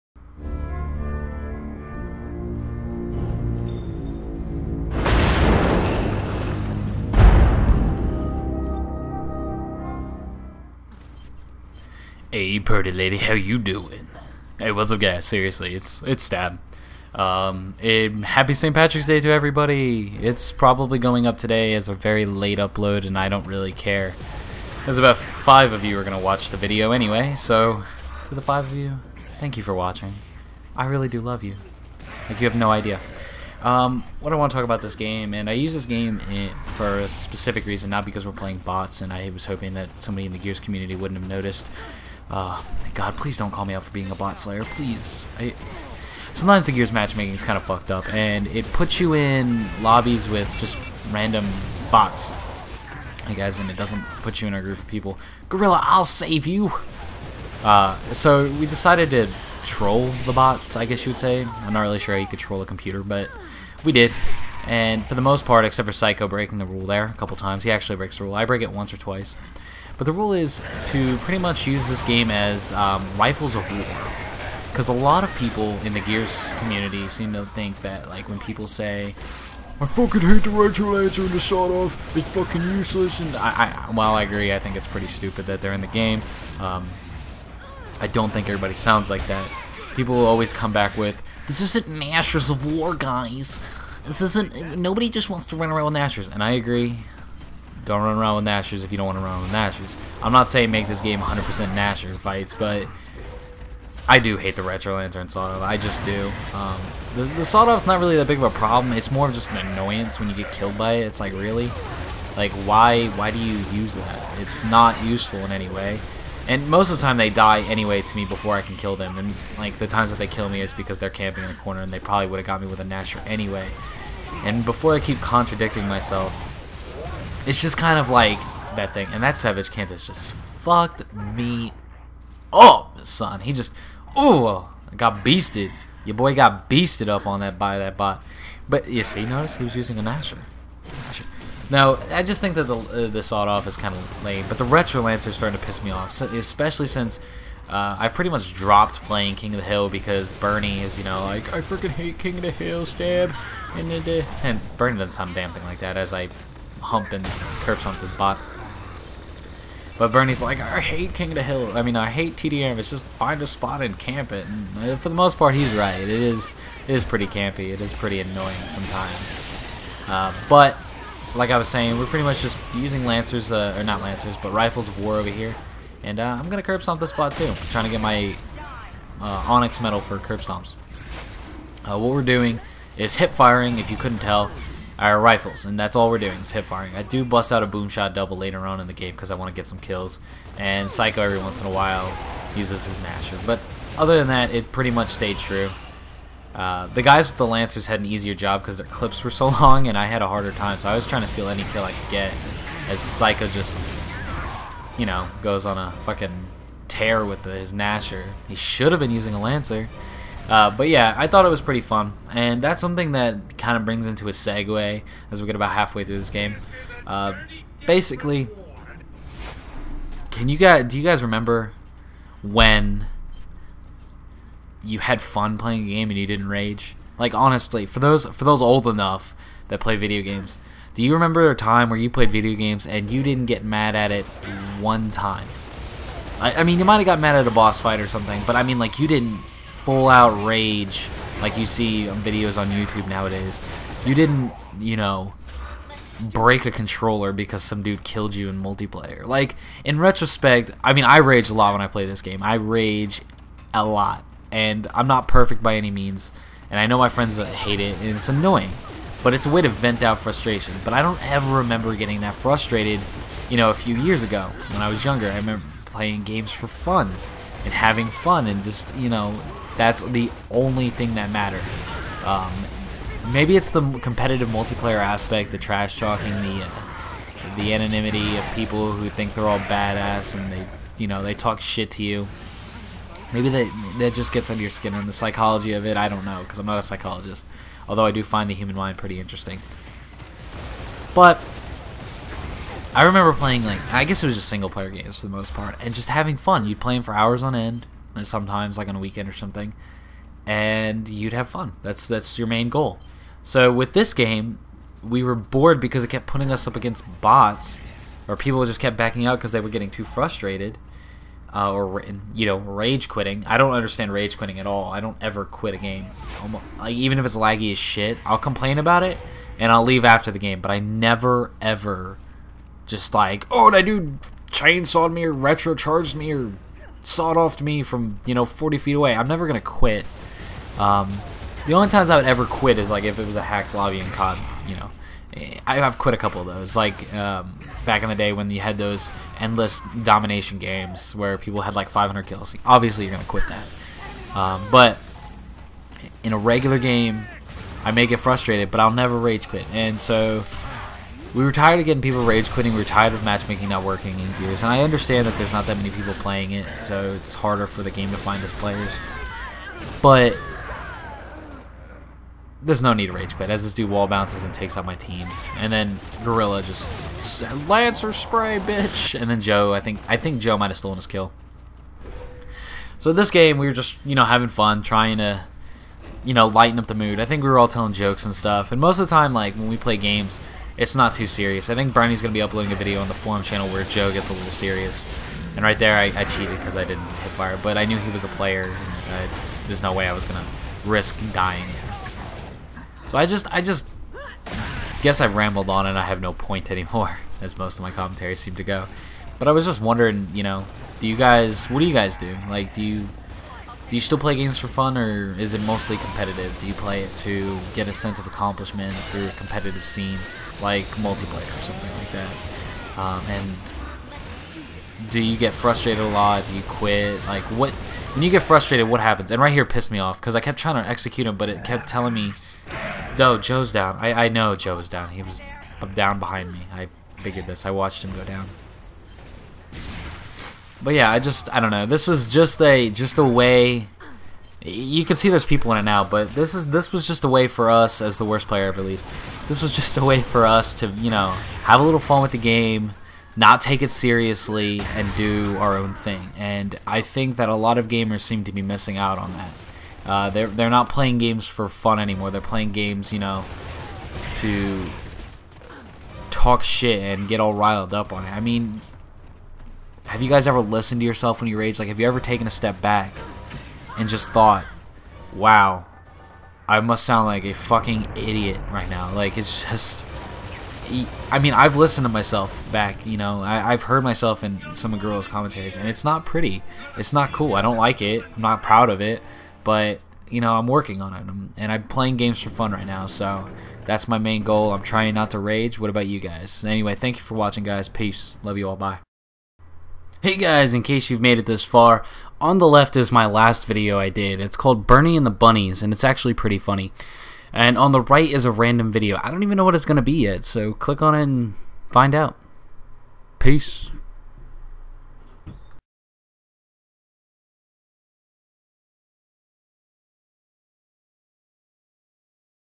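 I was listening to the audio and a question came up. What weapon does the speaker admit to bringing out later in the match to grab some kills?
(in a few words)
Boom shot.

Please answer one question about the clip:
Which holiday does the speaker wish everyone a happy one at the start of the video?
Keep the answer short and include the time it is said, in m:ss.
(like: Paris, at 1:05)
St. Patrick's Day, at 0:18.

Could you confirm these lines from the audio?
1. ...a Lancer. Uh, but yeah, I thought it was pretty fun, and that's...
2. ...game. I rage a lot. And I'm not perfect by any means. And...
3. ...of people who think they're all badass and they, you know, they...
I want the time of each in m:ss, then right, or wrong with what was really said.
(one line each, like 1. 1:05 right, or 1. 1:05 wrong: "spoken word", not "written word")
1. 3:29 right
2. 4:12 right
3. 4:38 right.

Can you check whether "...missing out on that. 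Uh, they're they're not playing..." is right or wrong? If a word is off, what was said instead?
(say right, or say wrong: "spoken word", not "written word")
right.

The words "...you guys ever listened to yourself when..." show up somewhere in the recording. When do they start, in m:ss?
7:40.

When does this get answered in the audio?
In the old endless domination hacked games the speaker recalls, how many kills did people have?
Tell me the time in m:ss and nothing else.
5:41.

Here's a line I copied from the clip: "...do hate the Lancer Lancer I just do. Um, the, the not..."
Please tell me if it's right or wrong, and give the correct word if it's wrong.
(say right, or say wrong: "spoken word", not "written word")
wrong: "Retro", not "Lancer".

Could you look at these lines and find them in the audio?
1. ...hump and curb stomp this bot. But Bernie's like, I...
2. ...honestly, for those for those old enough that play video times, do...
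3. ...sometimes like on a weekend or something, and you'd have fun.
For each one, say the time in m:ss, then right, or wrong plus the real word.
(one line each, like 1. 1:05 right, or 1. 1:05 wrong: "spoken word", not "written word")
1. 2:36 right
2. 3:47 wrong: "games", not "times"
3. 4:58 right.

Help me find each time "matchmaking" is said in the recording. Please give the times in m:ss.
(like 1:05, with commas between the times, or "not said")
0:46, 5:53.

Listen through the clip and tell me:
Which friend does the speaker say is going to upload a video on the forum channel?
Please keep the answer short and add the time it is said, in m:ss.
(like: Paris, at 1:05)
Brownie, at 6:21.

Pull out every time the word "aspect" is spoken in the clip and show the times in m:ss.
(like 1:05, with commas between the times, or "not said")
4:34.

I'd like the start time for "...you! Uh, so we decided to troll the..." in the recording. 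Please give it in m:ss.
0:56.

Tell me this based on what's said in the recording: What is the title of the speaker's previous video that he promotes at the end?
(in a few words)
Bernie and the Bunnies.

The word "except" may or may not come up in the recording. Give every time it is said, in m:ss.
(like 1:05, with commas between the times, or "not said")
1:05.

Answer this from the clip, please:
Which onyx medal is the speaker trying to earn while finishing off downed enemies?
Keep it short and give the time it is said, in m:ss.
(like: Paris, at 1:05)
Curb stomps, at 3:00.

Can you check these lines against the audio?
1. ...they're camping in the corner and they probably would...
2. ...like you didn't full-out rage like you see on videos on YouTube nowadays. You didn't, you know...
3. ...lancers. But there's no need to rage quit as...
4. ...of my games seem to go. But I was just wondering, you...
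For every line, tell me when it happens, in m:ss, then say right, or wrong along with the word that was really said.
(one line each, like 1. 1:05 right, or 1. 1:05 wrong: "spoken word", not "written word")
1. 2:00 right
2. 3:58 right
3. 5:58 wrong: "players", not "lancers"
4. 6:37 wrong: "commentaries", not "games".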